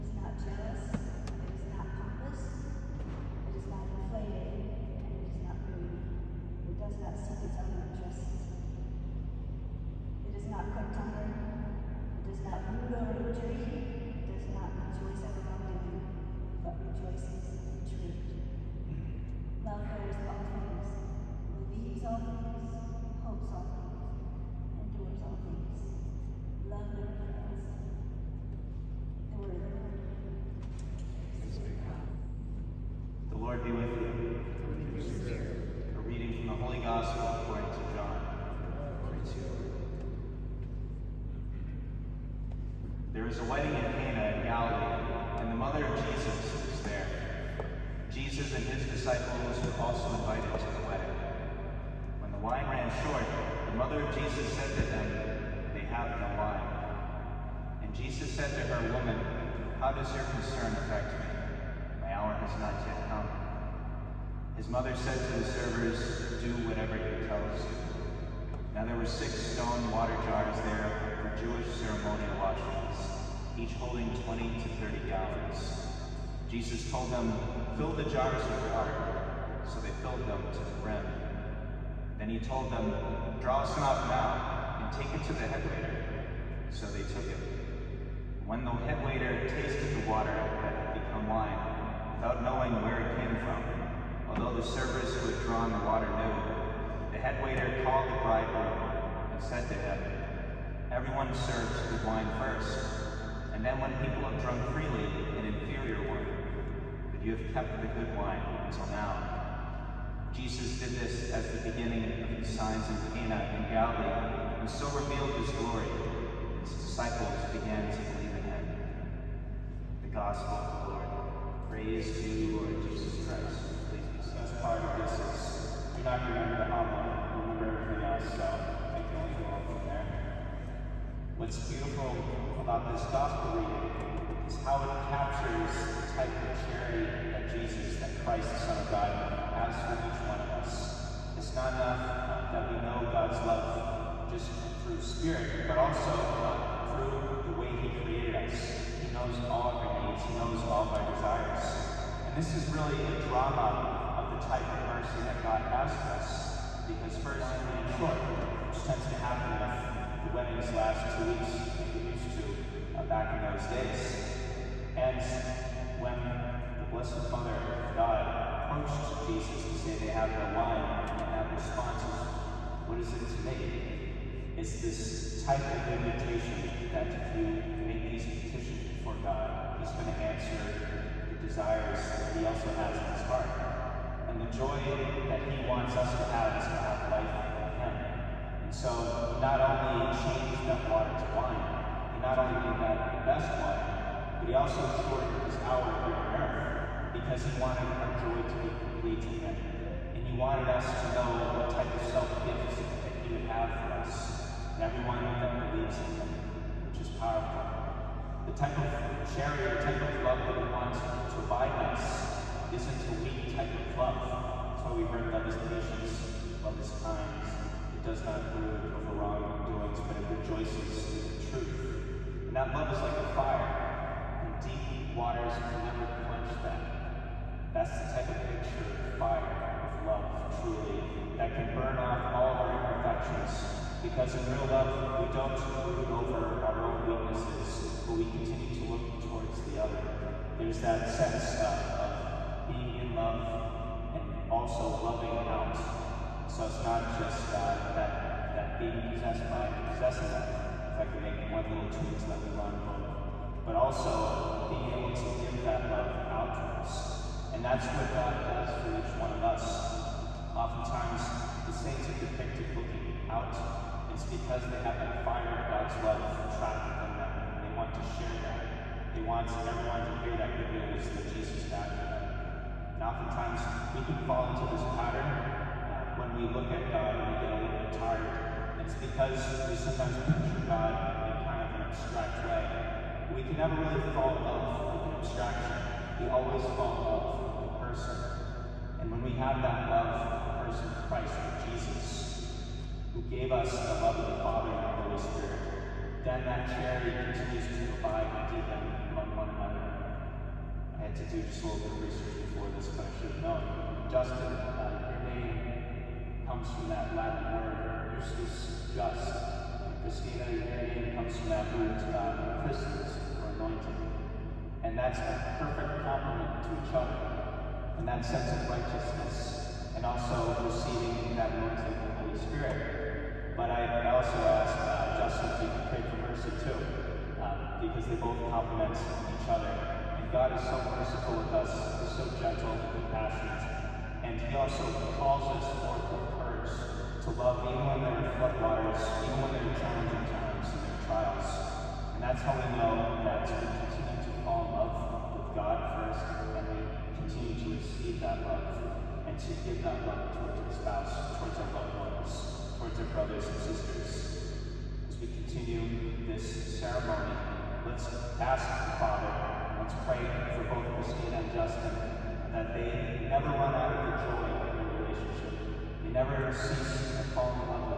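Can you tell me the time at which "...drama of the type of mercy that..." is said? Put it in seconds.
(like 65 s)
153 s.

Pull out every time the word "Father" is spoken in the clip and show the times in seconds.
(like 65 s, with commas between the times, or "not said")
294 s, 359 s.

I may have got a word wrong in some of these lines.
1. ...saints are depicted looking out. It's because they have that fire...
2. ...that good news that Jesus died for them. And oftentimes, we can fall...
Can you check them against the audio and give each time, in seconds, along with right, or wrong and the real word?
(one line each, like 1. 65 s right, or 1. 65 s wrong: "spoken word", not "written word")
1. 261 s right
2. 270 s right.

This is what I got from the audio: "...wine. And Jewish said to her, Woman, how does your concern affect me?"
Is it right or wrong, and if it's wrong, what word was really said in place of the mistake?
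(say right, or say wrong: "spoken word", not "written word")
wrong: "Jesus", not "Jewish".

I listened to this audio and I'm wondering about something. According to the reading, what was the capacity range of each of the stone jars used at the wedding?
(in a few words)
20 to 30 gallons.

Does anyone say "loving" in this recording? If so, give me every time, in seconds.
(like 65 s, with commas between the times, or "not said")
245 s.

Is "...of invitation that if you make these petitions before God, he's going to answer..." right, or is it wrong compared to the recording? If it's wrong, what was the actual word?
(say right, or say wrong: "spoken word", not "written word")
right.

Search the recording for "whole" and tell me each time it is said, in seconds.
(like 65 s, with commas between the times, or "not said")
not said.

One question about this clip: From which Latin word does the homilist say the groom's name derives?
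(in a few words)
justus.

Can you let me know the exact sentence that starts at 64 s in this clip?
His mother said to the servers, Do whatever he tells you.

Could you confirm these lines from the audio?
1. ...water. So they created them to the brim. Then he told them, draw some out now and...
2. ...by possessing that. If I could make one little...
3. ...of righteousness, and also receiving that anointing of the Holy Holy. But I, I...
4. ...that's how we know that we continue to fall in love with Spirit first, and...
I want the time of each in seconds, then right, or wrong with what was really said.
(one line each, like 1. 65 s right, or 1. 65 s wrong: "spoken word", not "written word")
1. 78 s wrong: "filled", not "created"
2. 249 s right
3. 318 s wrong: "Spirit", not "Holy"
4. 342 s wrong: "God", not "Spirit".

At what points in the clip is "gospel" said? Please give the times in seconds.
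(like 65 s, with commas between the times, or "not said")
120 s, 133 s.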